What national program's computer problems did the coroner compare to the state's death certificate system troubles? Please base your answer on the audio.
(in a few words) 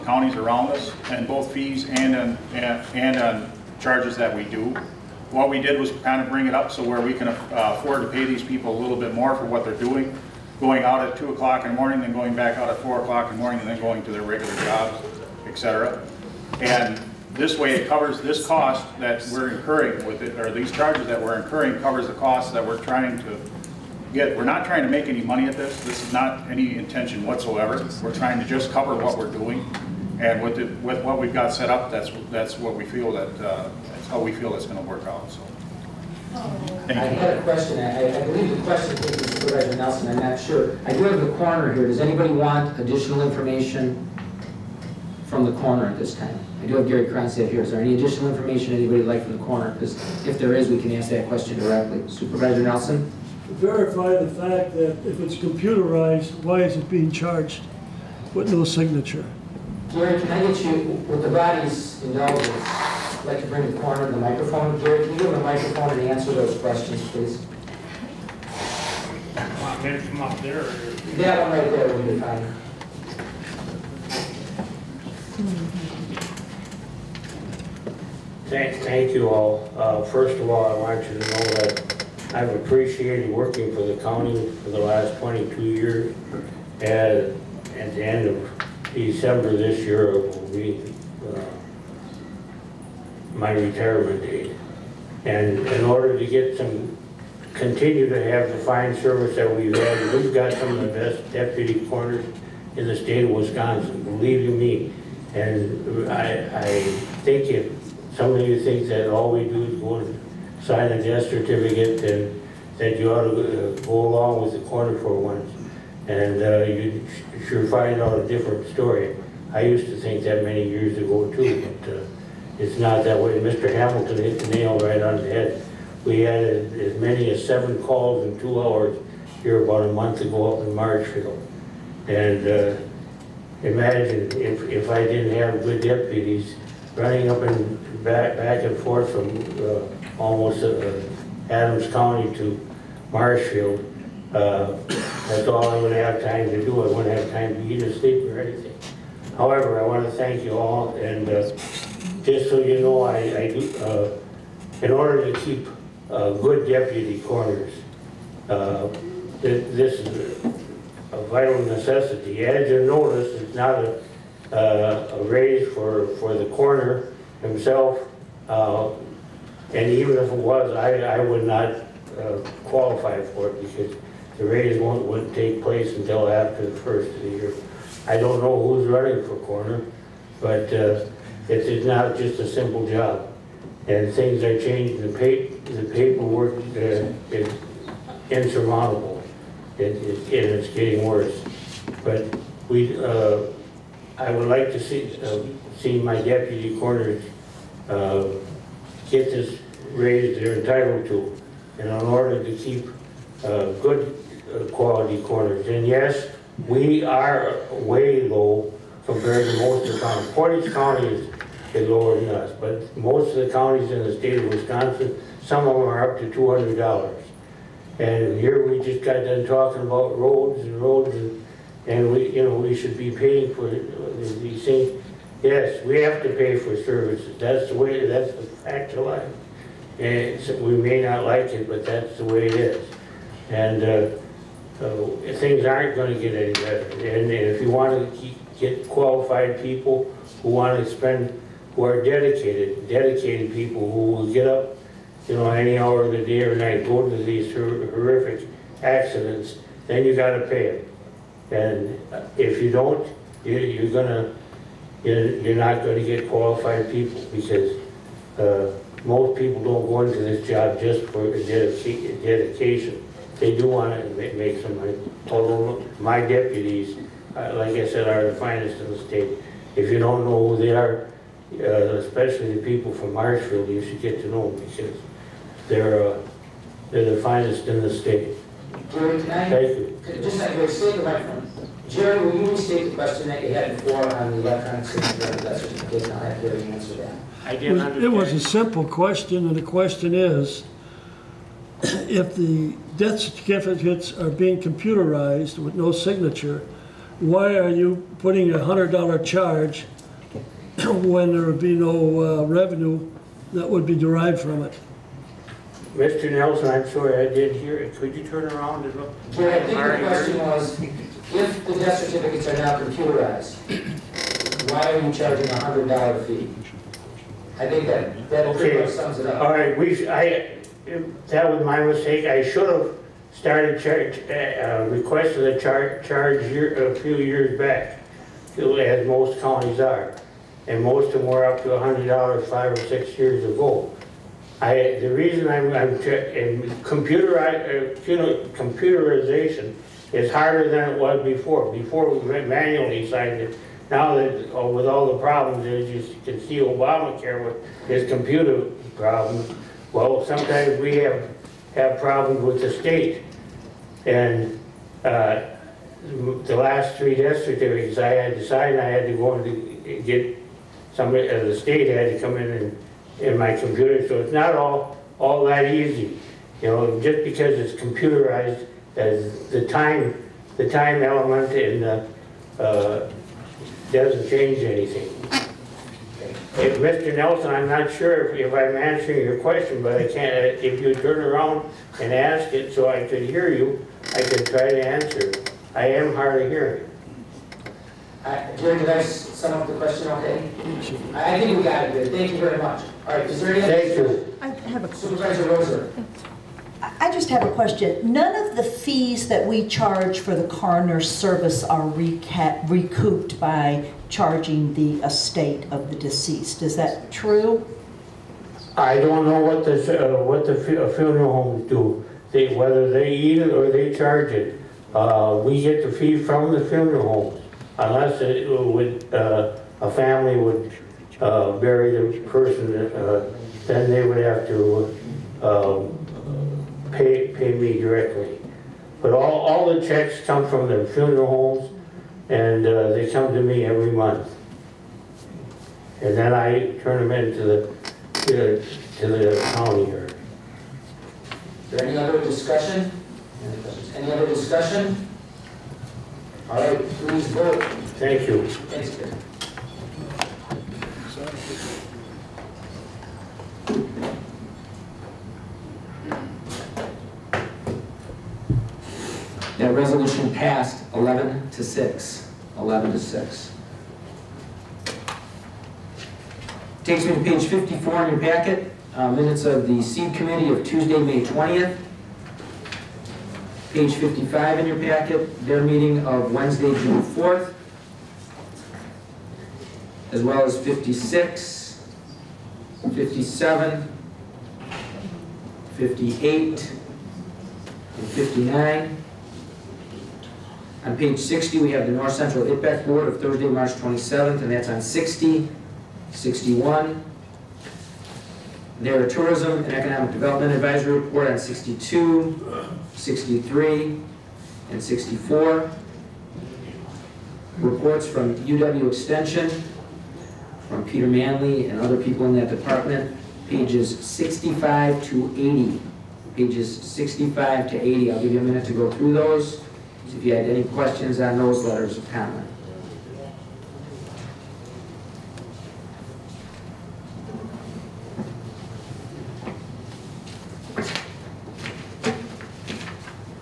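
Obamacare.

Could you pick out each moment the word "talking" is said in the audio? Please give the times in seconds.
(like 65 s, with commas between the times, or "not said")
219 s.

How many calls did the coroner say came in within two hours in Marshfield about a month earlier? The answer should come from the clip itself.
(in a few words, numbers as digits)
7.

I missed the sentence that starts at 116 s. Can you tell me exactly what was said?
And uh, you sure find out a different story.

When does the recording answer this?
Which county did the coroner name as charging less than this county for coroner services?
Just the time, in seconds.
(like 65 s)
210 s.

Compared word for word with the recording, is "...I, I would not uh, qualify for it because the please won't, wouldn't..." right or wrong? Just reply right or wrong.
wrong.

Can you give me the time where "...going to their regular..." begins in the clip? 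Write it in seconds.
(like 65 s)
13 s.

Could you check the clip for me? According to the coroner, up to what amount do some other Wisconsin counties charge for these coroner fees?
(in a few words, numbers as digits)
$200.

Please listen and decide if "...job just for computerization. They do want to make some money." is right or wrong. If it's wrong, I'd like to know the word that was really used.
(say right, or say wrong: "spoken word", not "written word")
wrong: "dedication", not "computerization".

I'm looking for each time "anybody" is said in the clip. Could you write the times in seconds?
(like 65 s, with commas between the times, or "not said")
41 s, 48 s.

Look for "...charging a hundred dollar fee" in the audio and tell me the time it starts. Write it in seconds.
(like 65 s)
315 s.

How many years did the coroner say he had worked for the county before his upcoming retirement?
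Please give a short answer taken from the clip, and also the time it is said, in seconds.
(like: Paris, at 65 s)
22, at 85 s.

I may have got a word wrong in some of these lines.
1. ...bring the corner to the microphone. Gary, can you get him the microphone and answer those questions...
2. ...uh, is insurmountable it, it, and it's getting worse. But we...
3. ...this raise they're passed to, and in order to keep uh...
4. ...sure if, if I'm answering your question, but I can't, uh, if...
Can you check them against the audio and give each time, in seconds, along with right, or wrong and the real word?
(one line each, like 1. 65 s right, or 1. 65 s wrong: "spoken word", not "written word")
1. 63 s right
2. 186 s right
3. 199 s wrong: "entitled", not "passed"
4. 377 s right.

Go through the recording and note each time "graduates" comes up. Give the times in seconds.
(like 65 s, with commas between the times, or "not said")
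not said.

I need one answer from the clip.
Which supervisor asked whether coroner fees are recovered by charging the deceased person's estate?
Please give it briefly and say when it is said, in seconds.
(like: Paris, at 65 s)
Rosa, at 395 s.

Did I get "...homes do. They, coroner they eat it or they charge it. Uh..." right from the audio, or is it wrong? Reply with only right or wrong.
wrong.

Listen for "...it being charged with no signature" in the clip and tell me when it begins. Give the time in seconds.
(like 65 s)
56 s.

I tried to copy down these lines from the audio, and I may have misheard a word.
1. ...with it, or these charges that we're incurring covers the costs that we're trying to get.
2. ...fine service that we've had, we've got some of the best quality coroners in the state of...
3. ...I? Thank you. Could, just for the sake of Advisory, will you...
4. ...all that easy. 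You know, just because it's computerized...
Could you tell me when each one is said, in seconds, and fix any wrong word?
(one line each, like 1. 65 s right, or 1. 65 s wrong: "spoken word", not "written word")
1. 20 s right
2. 98 s wrong: "deputy", not "quality"
3. 279 s wrong: "Jerry", not "Advisory"
4. 365 s right.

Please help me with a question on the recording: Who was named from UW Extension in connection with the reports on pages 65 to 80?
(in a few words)
Peter Manley.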